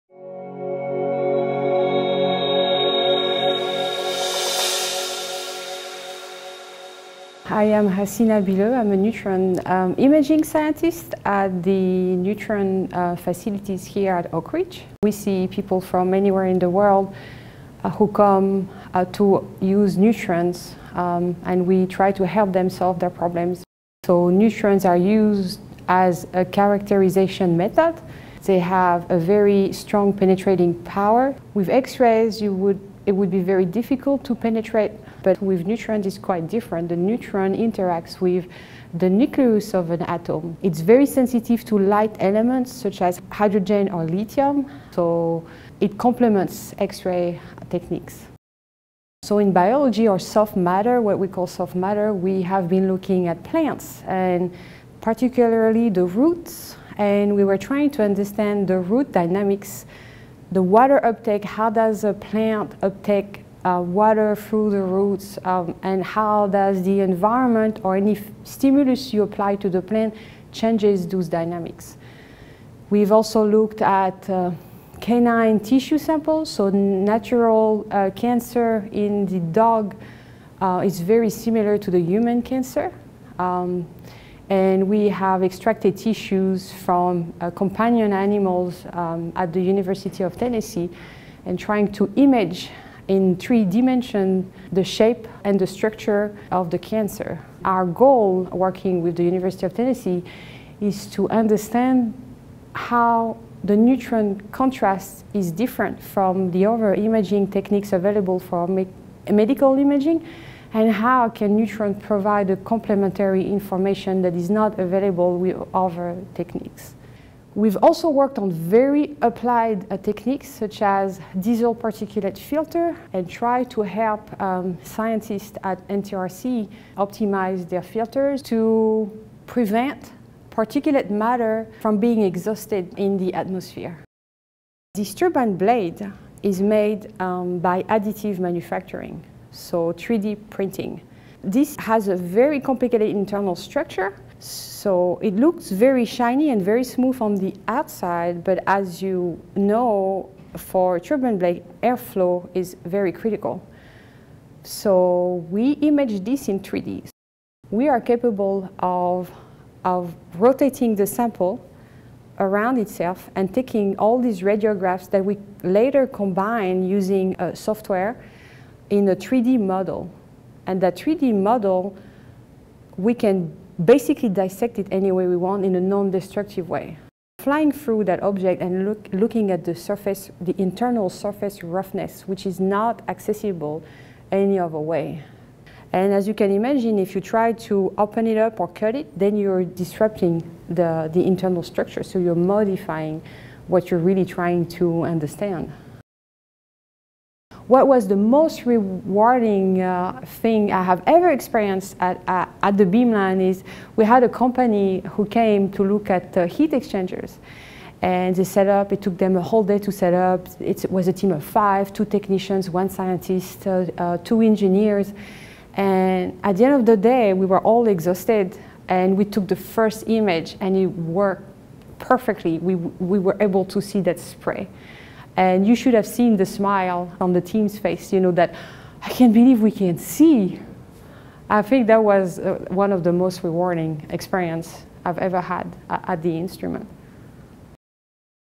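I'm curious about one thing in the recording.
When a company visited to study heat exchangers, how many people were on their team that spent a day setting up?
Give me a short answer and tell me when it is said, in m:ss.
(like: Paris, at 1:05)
5, at 3:31.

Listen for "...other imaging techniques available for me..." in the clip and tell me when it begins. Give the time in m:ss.
1:46.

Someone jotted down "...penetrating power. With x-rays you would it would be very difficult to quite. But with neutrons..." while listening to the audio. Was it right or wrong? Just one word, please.
wrong.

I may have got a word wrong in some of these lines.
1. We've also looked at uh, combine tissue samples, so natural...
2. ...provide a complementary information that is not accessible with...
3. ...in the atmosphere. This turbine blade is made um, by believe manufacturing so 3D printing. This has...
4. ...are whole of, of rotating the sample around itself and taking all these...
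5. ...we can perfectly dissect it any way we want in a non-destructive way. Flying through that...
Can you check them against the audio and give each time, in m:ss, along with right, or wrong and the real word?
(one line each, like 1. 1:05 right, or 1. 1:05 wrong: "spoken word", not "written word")
1. 1:12 wrong: "canine", not "combine"
2. 1:51 wrong: "available", not "accessible"
3. 2:12 wrong: "additive", not "believe"
4. 2:37 wrong: "capable", not "whole"
5. 2:52 wrong: "basically", not "perfectly".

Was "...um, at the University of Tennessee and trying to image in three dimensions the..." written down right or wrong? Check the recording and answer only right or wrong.
right.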